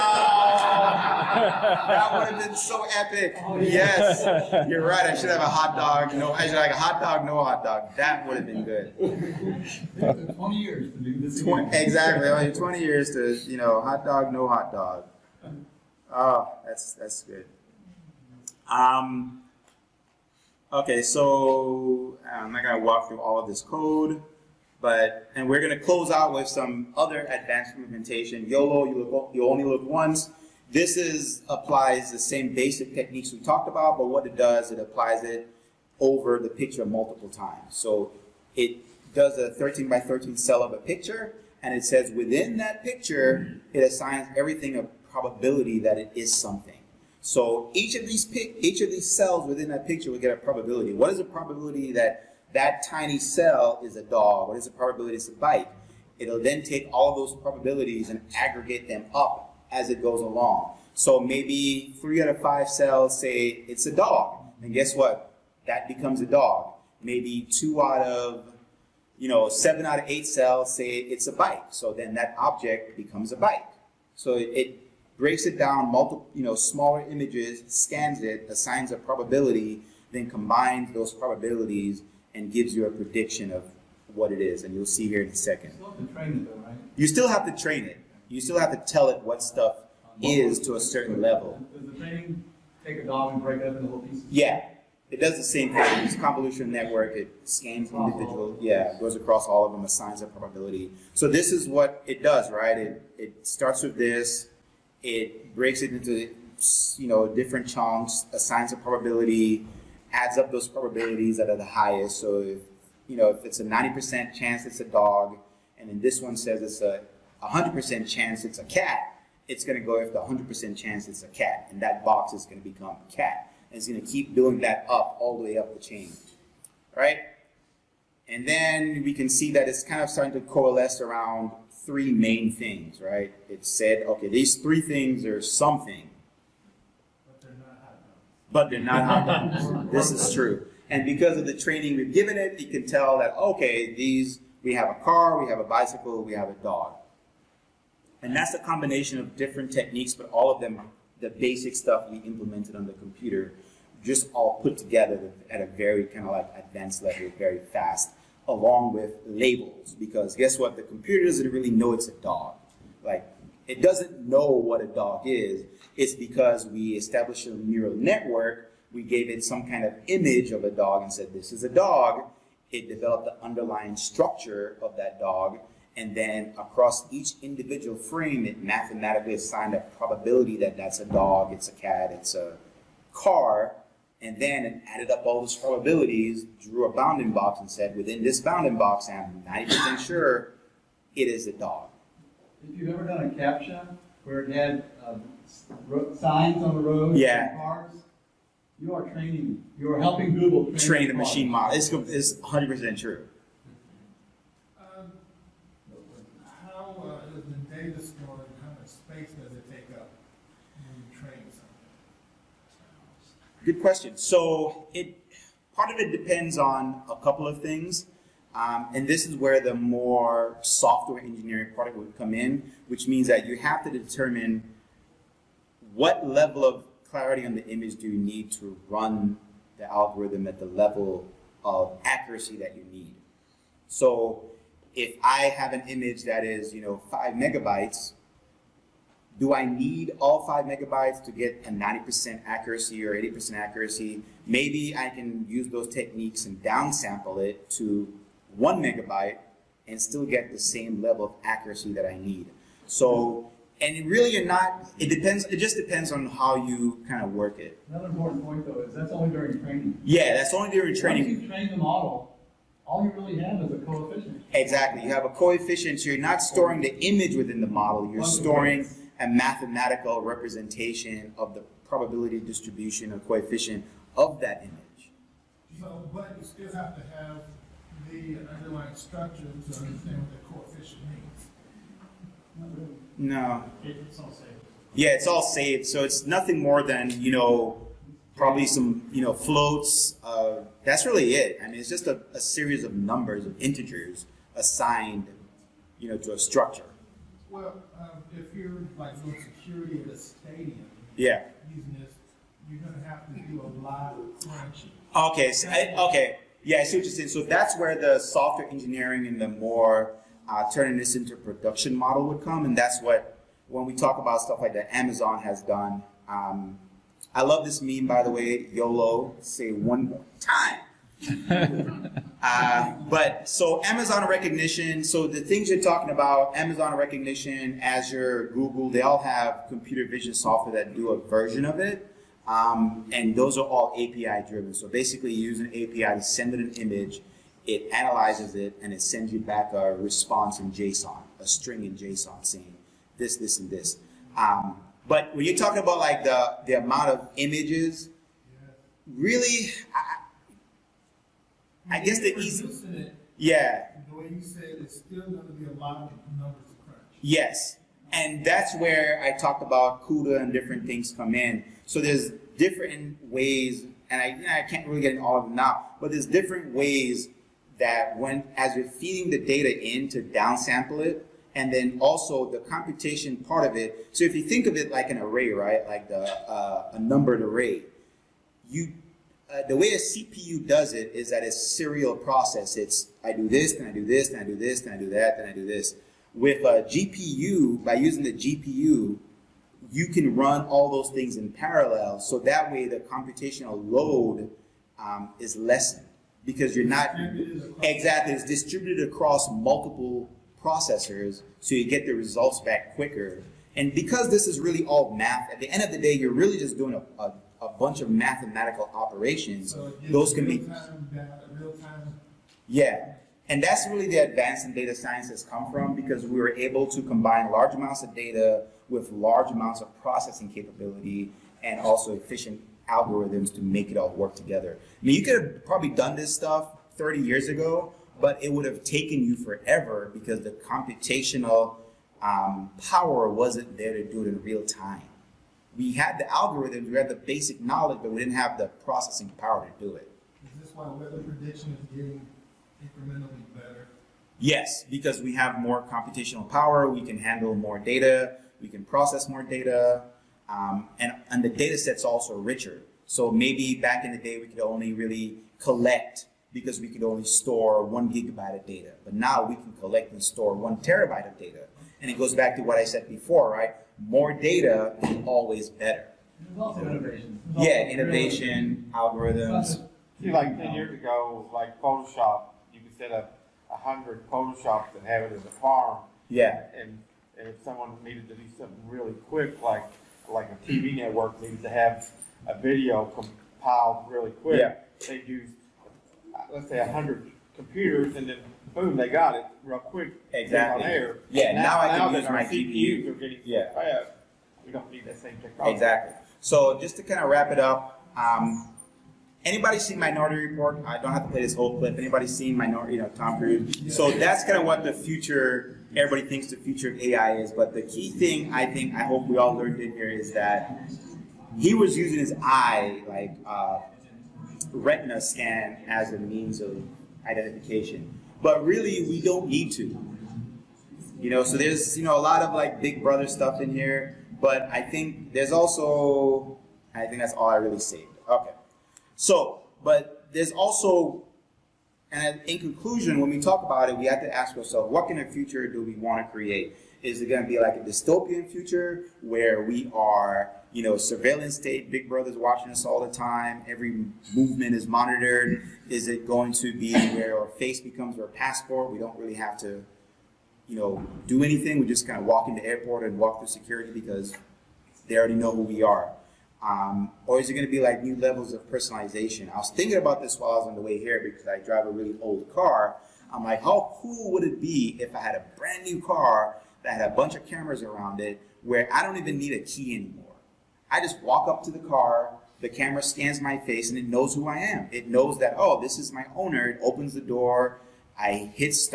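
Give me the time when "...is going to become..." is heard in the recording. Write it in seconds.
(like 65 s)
122 s.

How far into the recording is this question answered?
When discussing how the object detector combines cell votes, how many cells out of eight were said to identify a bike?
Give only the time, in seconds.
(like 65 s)
69 s.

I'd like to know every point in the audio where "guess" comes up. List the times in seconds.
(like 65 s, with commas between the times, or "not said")
64 s, 160 s, 351 s.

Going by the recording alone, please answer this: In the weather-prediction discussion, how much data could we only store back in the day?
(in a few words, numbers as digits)
1 gigabyte.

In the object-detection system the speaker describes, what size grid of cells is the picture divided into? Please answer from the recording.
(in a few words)
13 by 13.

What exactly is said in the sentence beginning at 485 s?
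they do, let's say, 100 computers, and then boom, they got it real quick.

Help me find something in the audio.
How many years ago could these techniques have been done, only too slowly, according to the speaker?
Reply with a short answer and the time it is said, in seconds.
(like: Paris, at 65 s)
30, at 426 s.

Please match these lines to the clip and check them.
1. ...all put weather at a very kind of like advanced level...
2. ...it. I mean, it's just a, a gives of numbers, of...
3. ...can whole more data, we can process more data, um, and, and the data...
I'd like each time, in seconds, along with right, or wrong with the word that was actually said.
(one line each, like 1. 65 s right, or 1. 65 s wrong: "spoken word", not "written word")
1. 154 s wrong: "together", not "weather"
2. 291 s wrong: "series", not "gives"
3. 447 s wrong: "handle", not "whole".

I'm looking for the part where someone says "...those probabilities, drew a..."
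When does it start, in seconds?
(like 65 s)
185 s.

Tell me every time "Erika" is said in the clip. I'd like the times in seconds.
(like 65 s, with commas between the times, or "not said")
not said.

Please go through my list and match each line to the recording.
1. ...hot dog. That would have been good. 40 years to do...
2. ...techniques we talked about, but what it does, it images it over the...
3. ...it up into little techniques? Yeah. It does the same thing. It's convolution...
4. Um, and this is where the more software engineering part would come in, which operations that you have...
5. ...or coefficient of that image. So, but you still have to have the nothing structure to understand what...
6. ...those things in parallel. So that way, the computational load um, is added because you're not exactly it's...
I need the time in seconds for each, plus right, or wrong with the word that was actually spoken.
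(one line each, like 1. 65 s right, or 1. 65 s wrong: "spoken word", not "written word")
1. 7 s wrong: "20", not "40"
2. 32 s wrong: "applies", not "images"
3. 93 s wrong: "pieces", not "techniques"
4. 218 s wrong: "means", not "operations"
5. 273 s wrong: "underlying", not "nothing"
6. 390 s wrong: "lessened", not "added".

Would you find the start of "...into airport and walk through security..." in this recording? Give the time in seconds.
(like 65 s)
552 s.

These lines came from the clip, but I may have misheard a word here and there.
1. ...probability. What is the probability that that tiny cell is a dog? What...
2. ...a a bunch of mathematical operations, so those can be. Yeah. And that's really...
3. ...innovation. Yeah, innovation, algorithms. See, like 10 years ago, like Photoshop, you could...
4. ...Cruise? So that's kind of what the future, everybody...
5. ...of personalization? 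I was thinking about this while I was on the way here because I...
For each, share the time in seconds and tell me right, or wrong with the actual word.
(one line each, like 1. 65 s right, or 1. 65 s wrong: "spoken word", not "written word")
1. 50 s right
2. 407 s right
3. 466 s right
4. 503 s right
5. 558 s right.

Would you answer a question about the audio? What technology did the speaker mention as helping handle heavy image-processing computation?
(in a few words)
CUDA.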